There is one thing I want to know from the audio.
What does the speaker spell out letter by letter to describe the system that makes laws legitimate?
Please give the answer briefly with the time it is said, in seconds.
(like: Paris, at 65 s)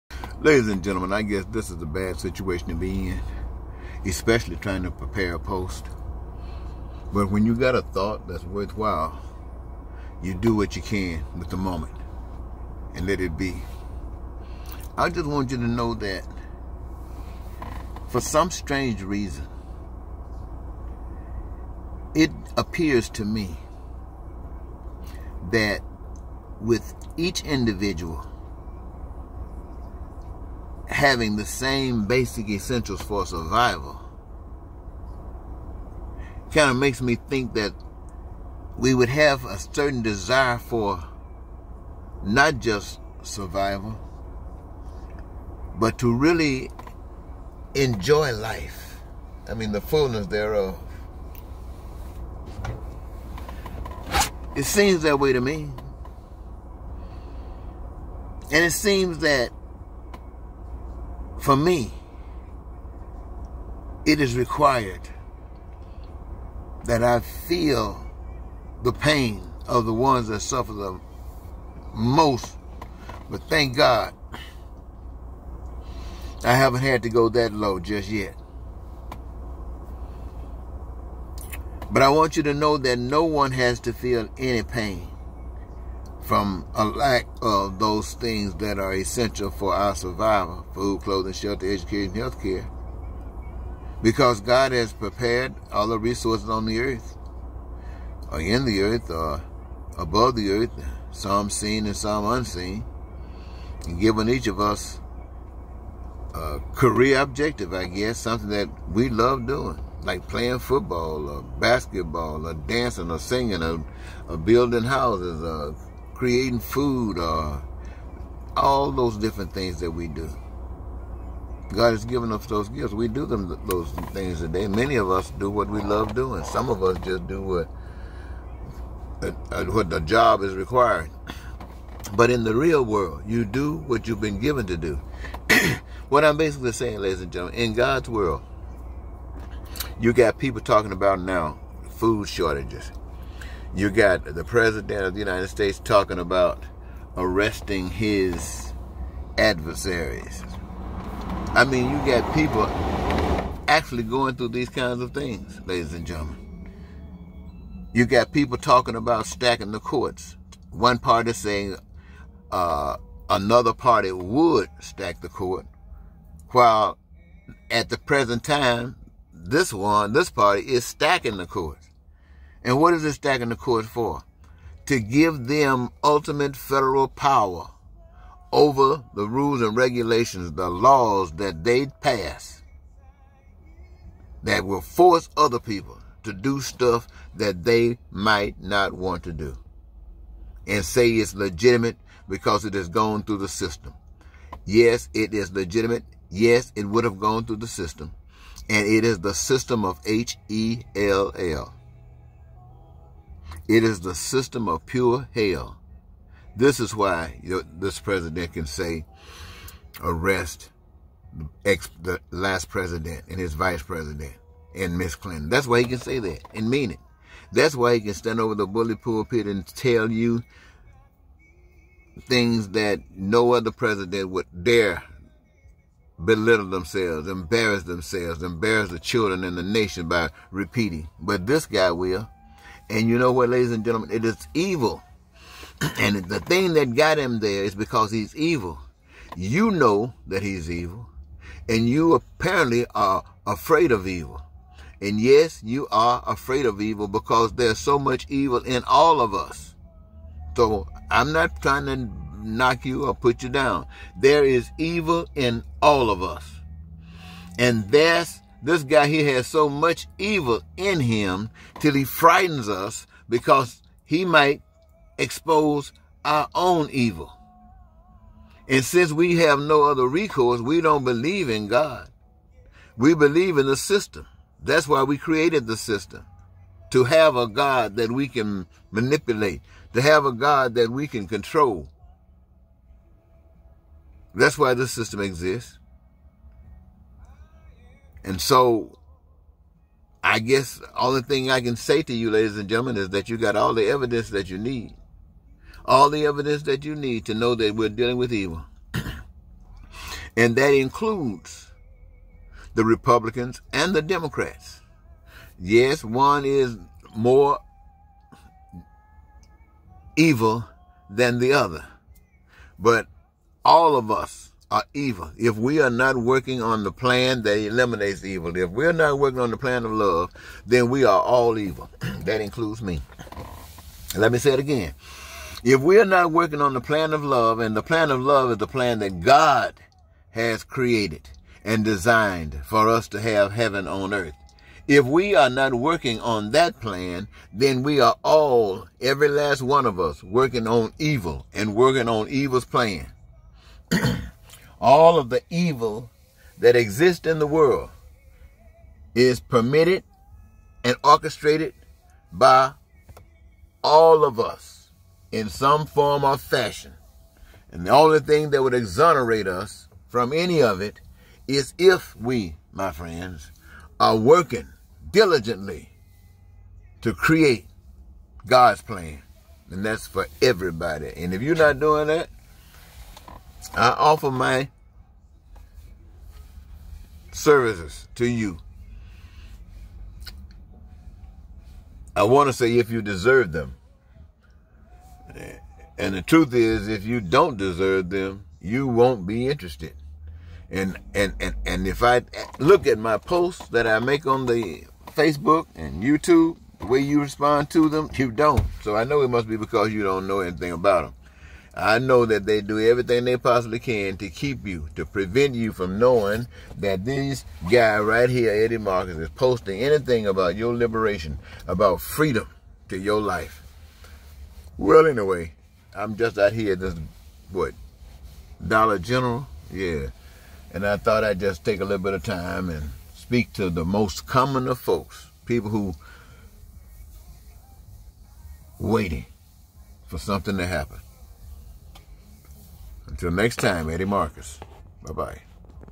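HELL, at 200 s.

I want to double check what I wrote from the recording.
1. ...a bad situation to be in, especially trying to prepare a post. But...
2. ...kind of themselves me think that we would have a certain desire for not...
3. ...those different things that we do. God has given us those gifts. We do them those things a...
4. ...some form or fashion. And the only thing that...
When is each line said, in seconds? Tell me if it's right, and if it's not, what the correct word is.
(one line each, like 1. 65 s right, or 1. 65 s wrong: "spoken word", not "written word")
1. 1 s right
2. 36 s wrong: "makes", not "themselves"
3. 118 s right
4. 355 s right.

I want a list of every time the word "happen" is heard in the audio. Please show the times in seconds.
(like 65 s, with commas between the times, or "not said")
430 s.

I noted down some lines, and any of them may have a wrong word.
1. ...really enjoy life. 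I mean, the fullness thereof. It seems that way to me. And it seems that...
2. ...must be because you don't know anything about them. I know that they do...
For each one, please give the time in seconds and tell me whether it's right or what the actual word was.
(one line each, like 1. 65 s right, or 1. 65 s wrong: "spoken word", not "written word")
1. 46 s right
2. 399 s right.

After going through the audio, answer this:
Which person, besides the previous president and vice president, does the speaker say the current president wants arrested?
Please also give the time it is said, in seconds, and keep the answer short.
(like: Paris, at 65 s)
Miss Clinton, at 214 s.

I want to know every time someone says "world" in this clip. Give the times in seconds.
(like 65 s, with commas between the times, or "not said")
132 s, 138 s, 347 s.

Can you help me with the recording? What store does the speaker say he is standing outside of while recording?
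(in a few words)
Dollar General.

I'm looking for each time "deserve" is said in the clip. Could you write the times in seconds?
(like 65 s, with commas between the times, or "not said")
383 s, 387 s.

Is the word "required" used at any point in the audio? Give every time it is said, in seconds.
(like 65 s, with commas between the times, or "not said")
64 s, 130 s.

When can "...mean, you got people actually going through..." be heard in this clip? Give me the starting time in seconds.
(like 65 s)
151 s.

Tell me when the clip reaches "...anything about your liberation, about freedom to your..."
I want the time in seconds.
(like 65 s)
409 s.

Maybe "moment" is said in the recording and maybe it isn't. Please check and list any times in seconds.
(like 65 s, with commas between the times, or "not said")
11 s.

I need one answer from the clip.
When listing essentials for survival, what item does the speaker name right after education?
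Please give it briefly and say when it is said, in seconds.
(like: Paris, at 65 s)
health care, at 92 s.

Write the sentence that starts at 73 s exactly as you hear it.
But thank God, I haven't had to go that low just yet.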